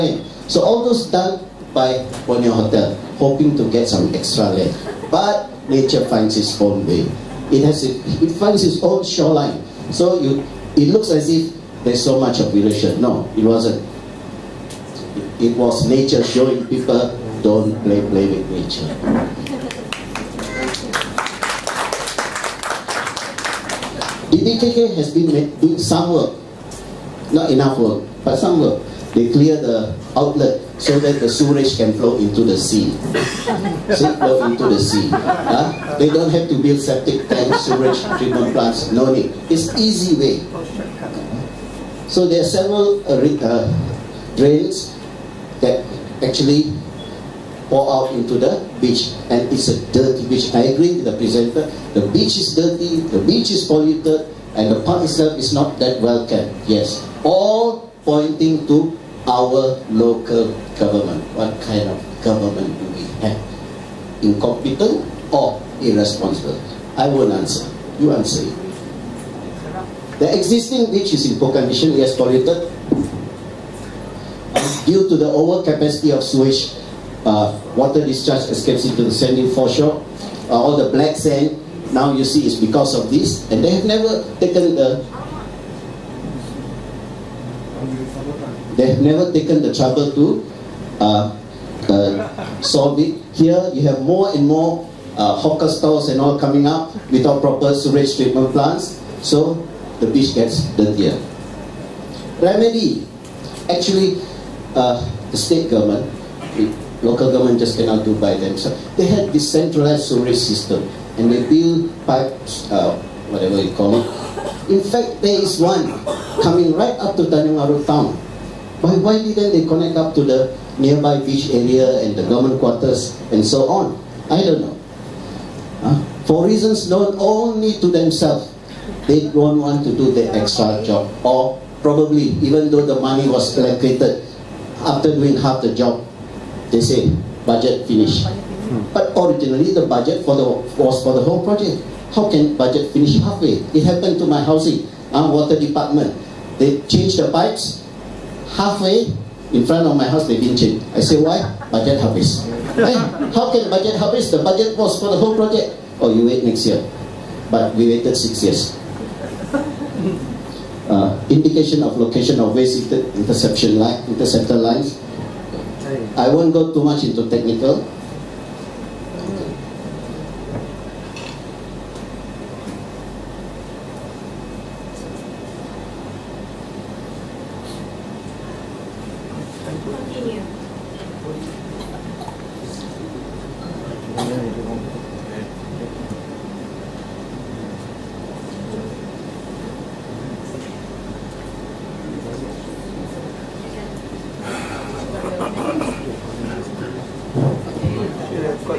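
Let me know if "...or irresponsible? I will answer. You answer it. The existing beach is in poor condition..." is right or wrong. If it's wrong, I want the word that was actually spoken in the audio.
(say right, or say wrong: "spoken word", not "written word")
right.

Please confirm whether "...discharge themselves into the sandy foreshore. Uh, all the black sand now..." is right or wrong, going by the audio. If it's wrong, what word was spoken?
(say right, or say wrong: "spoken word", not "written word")
wrong: "escapes", not "themselves".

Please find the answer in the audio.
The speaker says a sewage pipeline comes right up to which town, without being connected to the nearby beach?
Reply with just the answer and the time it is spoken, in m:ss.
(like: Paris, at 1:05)
Tanjung Aru, at 1:57.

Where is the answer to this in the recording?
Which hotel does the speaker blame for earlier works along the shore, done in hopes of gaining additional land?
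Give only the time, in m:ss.
0:02.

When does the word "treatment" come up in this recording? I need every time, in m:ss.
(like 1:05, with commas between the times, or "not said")
0:38, 1:38.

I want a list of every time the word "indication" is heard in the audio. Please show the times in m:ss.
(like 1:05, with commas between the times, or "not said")
2:41.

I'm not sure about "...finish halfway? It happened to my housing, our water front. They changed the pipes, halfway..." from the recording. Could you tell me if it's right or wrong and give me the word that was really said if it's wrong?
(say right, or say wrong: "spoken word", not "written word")
wrong: "department", not "front".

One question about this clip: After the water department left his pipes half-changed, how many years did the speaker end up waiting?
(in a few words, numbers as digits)
6.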